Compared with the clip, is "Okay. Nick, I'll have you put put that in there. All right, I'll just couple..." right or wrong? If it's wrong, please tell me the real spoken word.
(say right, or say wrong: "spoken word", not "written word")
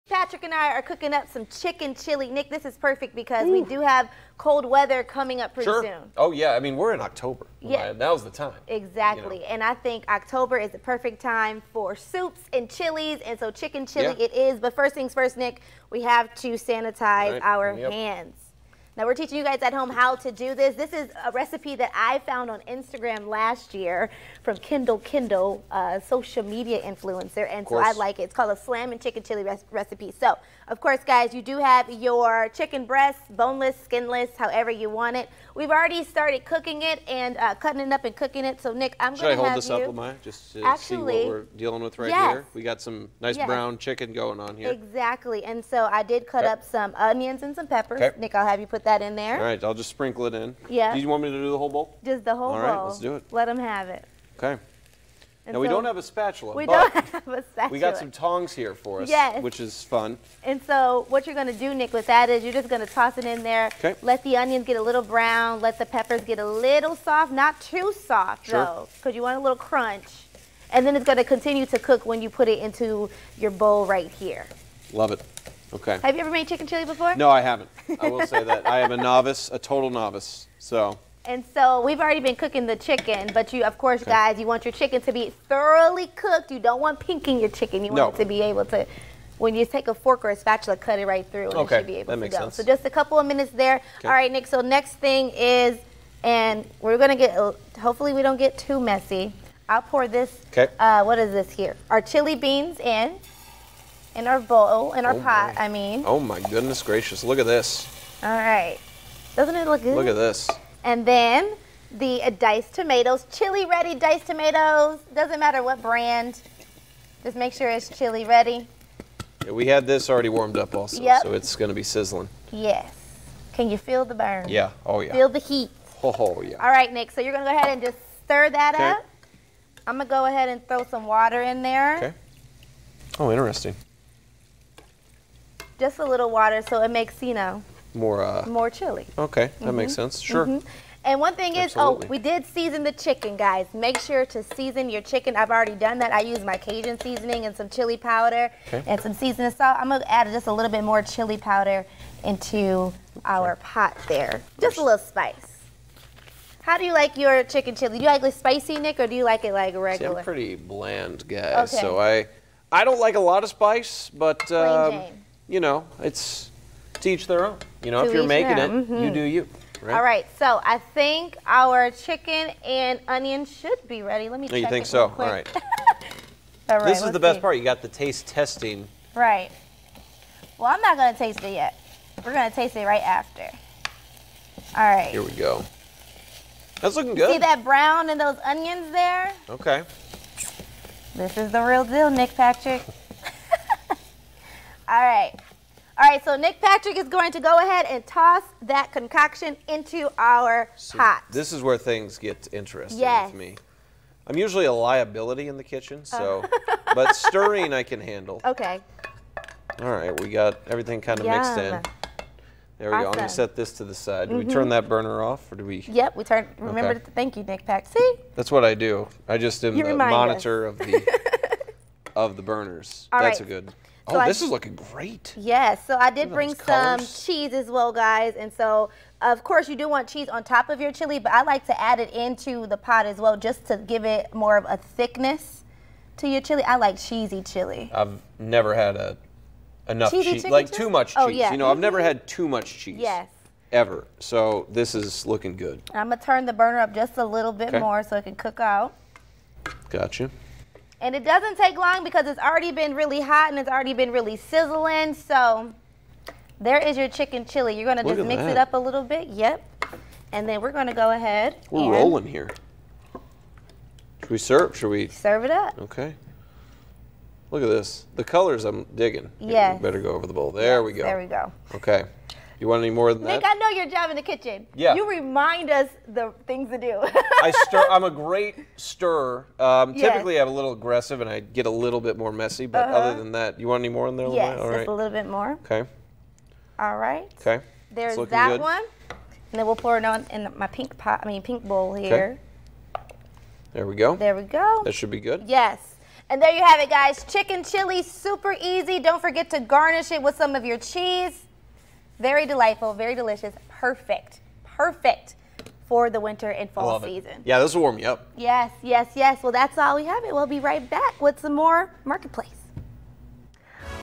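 wrong: "sprinkle", not "couple".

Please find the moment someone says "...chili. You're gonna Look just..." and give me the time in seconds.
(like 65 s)
257 s.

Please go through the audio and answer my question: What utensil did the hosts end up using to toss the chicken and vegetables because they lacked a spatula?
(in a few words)
Tongs.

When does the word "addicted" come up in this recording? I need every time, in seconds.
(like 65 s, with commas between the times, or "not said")
not said.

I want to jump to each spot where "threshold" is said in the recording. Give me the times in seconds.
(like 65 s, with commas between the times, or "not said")
not said.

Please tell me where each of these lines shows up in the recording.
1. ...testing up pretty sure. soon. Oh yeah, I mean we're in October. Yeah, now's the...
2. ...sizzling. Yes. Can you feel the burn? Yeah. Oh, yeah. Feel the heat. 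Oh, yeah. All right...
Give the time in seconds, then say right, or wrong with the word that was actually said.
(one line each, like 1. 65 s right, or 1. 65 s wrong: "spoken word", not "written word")
1. 5 s wrong: "coming", not "testing"
2. 121 s right.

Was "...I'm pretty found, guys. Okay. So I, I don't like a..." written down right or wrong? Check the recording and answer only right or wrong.
wrong.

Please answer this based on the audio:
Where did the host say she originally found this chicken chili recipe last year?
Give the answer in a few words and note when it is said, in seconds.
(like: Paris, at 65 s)
Instagram, at 22 s.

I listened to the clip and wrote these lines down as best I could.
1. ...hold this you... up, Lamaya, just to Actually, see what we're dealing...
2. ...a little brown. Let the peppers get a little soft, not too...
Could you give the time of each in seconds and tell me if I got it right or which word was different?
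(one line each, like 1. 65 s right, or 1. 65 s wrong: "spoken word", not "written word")
1. 39 s right
2. 64 s right.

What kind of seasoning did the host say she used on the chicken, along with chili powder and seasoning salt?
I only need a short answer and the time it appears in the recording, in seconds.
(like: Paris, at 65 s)
Cajun seasoning, at 146 s.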